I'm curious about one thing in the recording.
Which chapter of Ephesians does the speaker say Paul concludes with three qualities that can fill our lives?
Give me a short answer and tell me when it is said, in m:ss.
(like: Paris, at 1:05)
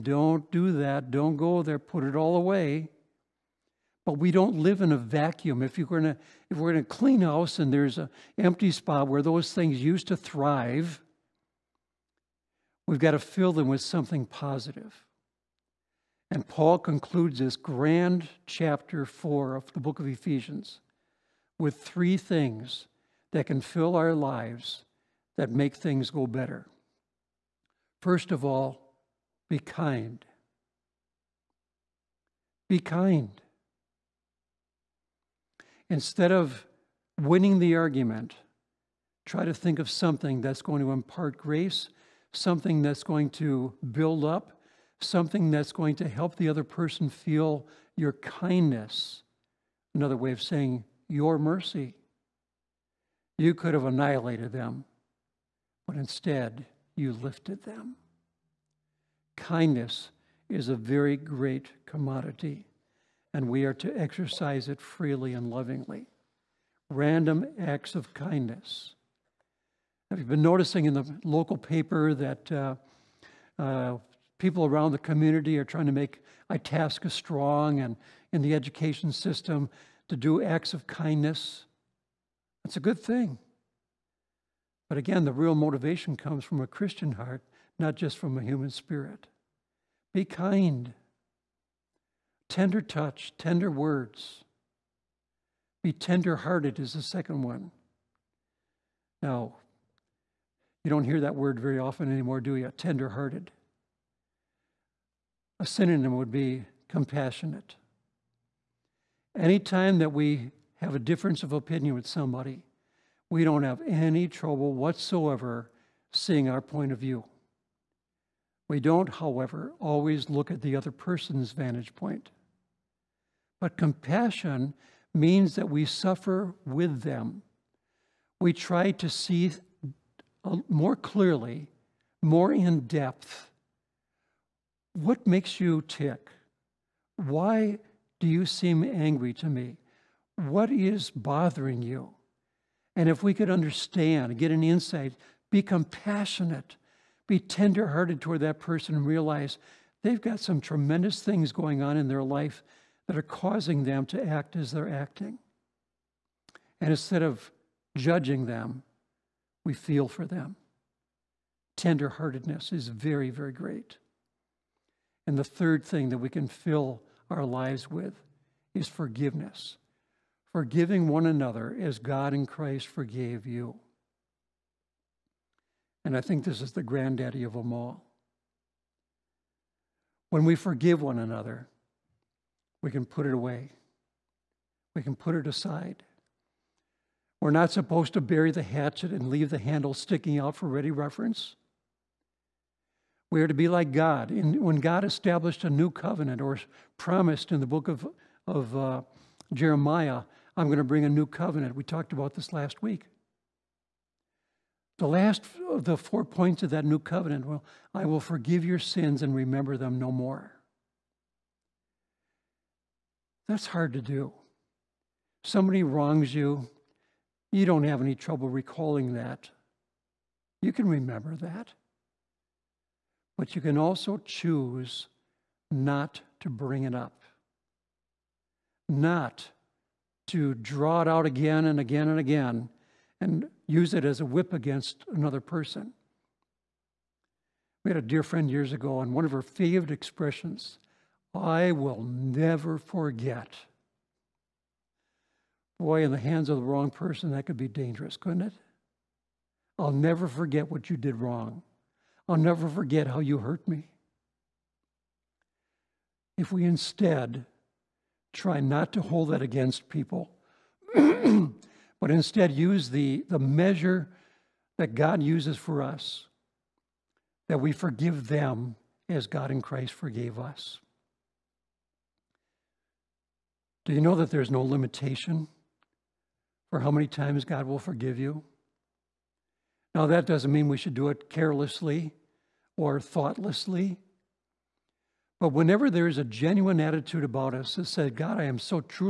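Chapter 4, at 0:18.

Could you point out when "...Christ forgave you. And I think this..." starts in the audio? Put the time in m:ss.
2:52.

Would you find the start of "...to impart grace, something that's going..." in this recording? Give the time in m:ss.
0:40.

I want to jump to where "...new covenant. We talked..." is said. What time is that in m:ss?
3:21.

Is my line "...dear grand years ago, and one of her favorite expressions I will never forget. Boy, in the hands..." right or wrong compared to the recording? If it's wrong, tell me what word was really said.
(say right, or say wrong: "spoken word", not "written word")
wrong: "friend", not "grand".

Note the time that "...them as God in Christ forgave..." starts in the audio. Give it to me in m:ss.
4:28.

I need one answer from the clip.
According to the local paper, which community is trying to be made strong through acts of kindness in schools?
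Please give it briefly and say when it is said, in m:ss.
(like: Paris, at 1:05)
Itasca, at 1:16.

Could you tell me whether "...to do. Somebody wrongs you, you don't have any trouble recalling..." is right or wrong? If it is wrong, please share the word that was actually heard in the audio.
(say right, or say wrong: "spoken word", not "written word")
right.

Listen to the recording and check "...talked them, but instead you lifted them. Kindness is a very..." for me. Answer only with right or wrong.
wrong.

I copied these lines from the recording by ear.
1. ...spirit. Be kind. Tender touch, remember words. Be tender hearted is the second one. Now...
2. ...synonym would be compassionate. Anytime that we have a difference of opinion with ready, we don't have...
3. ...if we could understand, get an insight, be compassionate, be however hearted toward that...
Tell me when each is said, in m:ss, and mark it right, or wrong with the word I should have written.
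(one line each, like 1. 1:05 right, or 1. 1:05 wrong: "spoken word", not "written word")
1. 1:28 wrong: "tender", not "remember"
2. 1:45 wrong: "somebody", not "ready"
3. 2:23 wrong: "tender", not "however".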